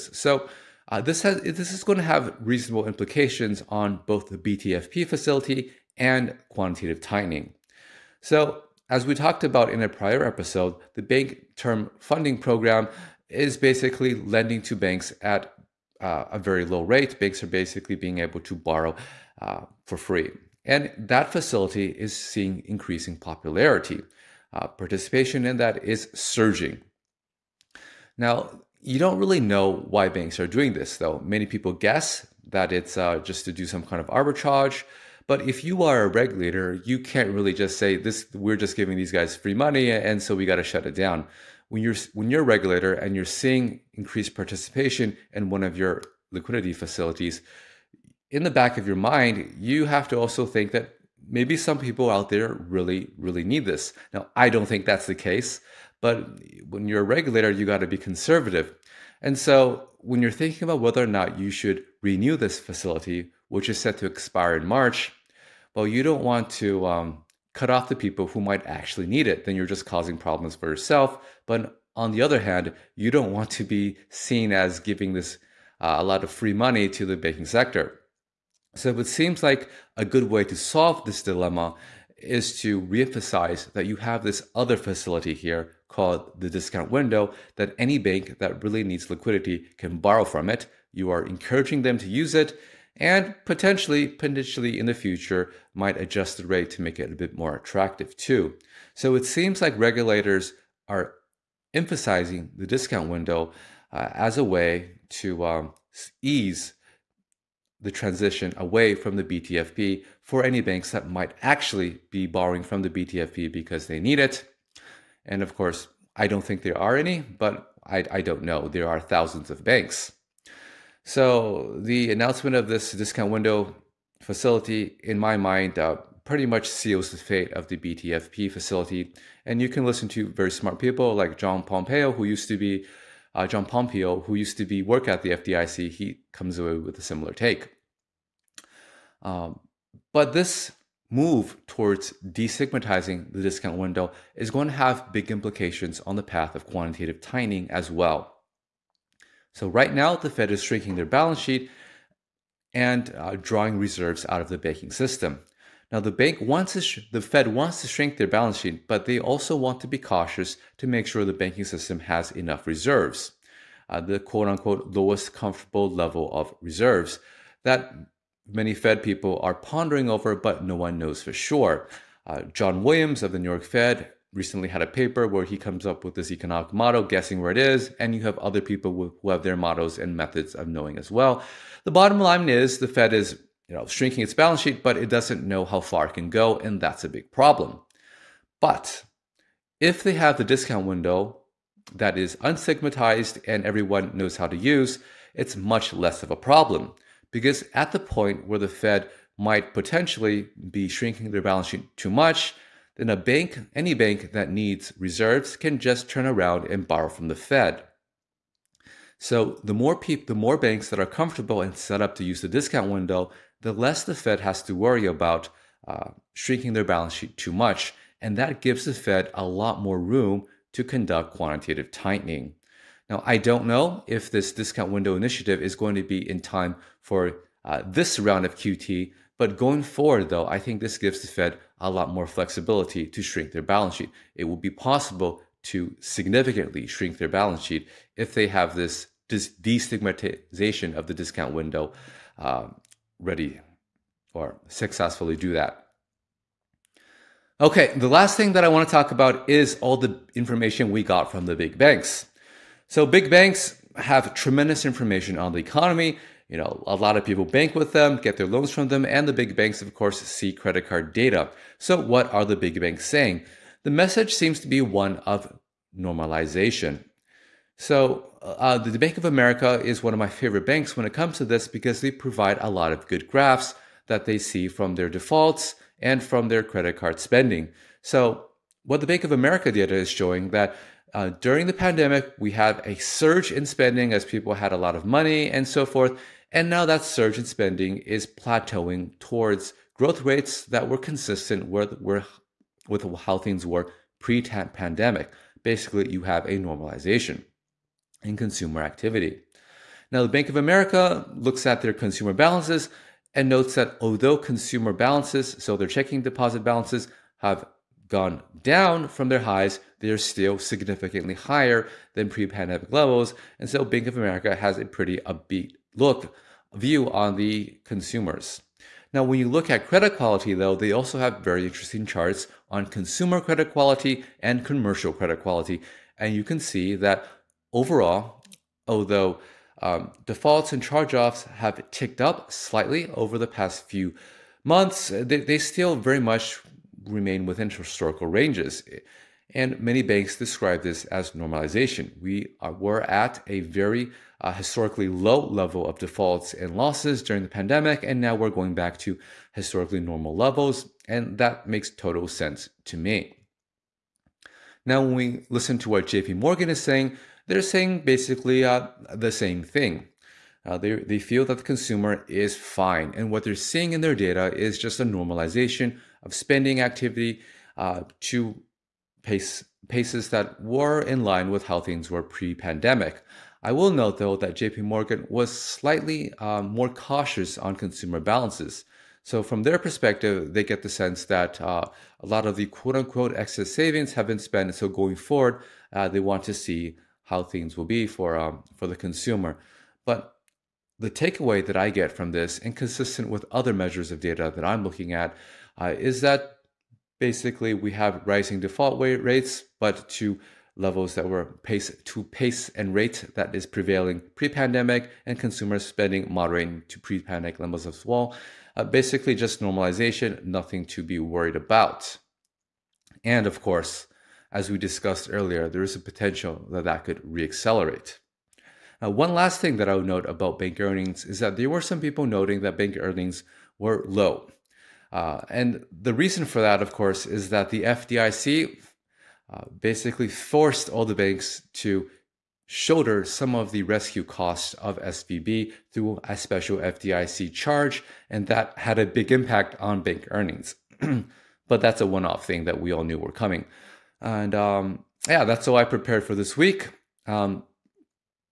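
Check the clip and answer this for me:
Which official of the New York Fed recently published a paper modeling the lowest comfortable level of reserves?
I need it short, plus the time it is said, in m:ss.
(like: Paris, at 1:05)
John Williams, at 2:52.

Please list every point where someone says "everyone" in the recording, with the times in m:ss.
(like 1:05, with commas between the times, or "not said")
3:13.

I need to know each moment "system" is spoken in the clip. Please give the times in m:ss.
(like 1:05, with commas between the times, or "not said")
2:34, 2:41.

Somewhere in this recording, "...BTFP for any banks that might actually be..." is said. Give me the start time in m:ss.
1:49.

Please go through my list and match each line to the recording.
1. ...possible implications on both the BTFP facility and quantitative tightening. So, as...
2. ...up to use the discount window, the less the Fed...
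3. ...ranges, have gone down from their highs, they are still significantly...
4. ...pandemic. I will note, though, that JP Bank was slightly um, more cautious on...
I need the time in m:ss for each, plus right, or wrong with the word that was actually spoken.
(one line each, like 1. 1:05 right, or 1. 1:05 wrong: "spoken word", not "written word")
1. 0:02 wrong: "reasonable", not "possible"
2. 3:32 right
3. 5:06 wrong: "balances", not "ranges"
4. 6:12 wrong: "Morgan", not "Bank".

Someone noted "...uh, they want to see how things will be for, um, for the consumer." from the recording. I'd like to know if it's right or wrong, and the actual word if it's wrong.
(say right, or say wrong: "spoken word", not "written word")
right.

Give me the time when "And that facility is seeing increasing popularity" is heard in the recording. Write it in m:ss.
0:20.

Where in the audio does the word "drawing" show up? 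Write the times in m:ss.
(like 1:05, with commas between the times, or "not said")
2:33.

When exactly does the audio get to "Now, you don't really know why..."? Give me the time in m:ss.
0:28.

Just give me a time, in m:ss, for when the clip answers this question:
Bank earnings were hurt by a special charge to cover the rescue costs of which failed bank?
7:14.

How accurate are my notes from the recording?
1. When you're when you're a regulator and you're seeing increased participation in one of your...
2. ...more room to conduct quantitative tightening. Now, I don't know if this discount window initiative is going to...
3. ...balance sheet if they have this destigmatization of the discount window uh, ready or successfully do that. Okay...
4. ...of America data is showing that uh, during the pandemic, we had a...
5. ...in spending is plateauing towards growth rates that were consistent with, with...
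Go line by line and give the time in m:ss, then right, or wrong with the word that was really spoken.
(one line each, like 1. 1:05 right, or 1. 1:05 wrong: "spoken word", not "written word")
1. 0:41 right
2. 3:39 right
3. 3:57 right
4. 4:39 right
5. 4:47 right.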